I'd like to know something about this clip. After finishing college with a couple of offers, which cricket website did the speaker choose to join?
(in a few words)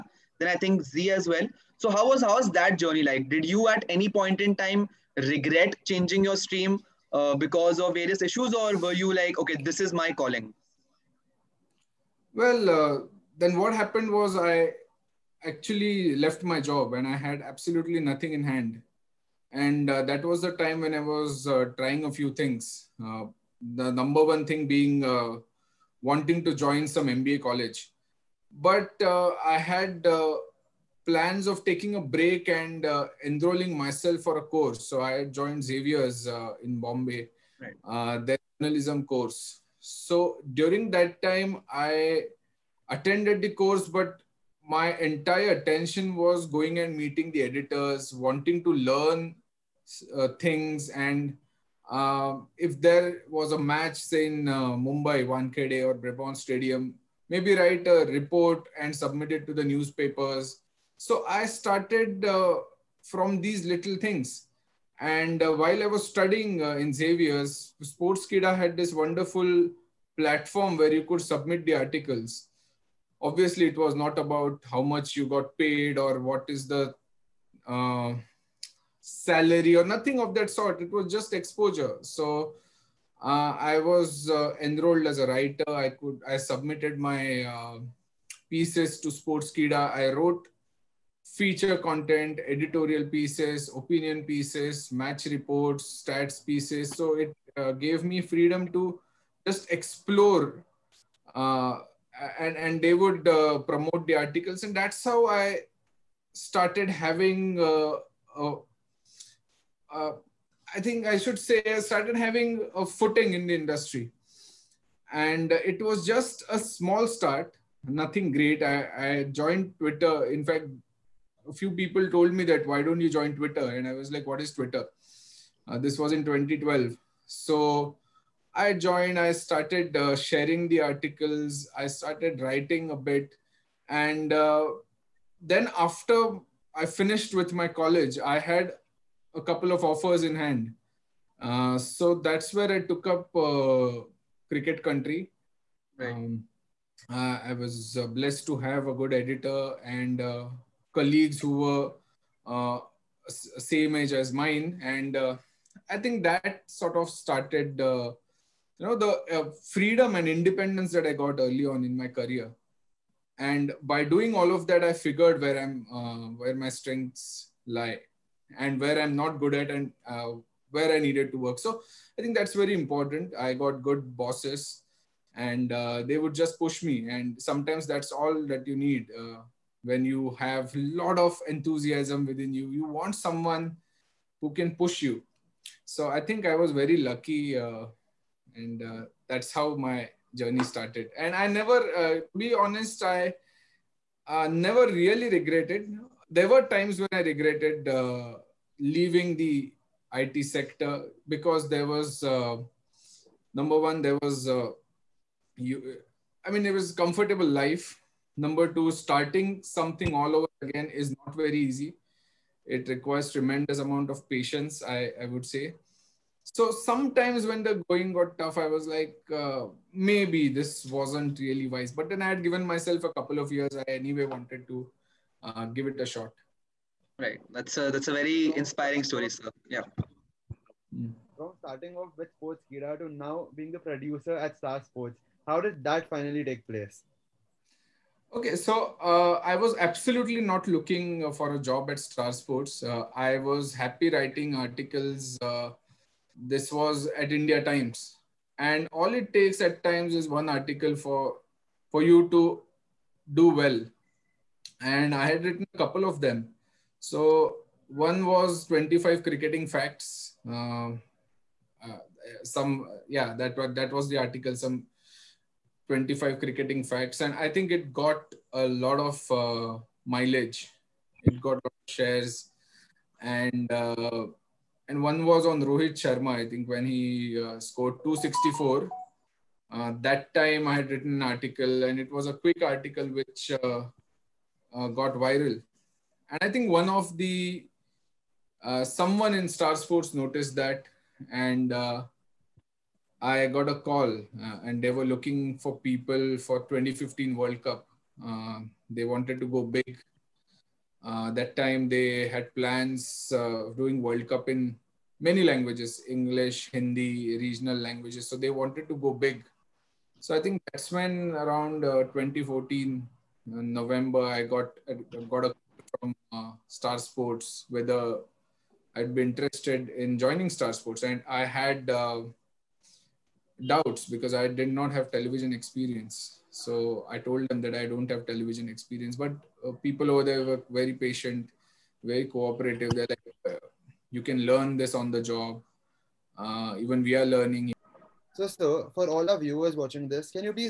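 Cricket Country.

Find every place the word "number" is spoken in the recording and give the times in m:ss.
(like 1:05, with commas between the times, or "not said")
0:23, 3:23, 3:28.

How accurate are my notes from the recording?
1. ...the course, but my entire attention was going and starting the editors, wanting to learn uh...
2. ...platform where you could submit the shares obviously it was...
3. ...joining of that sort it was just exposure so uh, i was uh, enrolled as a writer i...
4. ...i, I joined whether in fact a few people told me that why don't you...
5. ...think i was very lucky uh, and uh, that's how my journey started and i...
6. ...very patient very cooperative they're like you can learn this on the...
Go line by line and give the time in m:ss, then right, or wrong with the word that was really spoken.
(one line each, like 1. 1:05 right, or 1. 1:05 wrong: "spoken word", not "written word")
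1. 0:43 wrong: "meeting", not "starting"
2. 1:10 wrong: "articles", not "shares"
3. 1:19 wrong: "nothing", not "joining"
4. 1:58 wrong: "twitter", not "whether"
5. 3:06 right
6. 5:30 right.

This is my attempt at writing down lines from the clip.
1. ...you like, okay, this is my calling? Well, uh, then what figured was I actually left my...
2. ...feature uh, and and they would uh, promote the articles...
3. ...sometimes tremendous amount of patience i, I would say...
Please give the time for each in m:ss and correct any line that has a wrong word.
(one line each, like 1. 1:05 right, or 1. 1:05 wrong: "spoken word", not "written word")
1. 0:08 wrong: "happened", not "figured"
2. 1:39 wrong: "explore", not "feature"
3. 3:32 wrong: "requires", not "sometimes".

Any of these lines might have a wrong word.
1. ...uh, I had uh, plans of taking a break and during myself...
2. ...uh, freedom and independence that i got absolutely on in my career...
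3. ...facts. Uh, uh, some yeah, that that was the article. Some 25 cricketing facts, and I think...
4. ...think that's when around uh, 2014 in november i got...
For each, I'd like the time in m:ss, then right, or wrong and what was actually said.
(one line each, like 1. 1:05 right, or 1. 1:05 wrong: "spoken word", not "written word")
1. 0:29 wrong: "enrolling", not "during"
2. 2:39 wrong: "early", not "absolutely"
3. 4:19 right
4. 5:10 right.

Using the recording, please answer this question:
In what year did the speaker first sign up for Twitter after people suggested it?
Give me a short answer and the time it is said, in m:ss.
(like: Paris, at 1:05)
2012, at 2:06.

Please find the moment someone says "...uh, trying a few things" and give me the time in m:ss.
0:21.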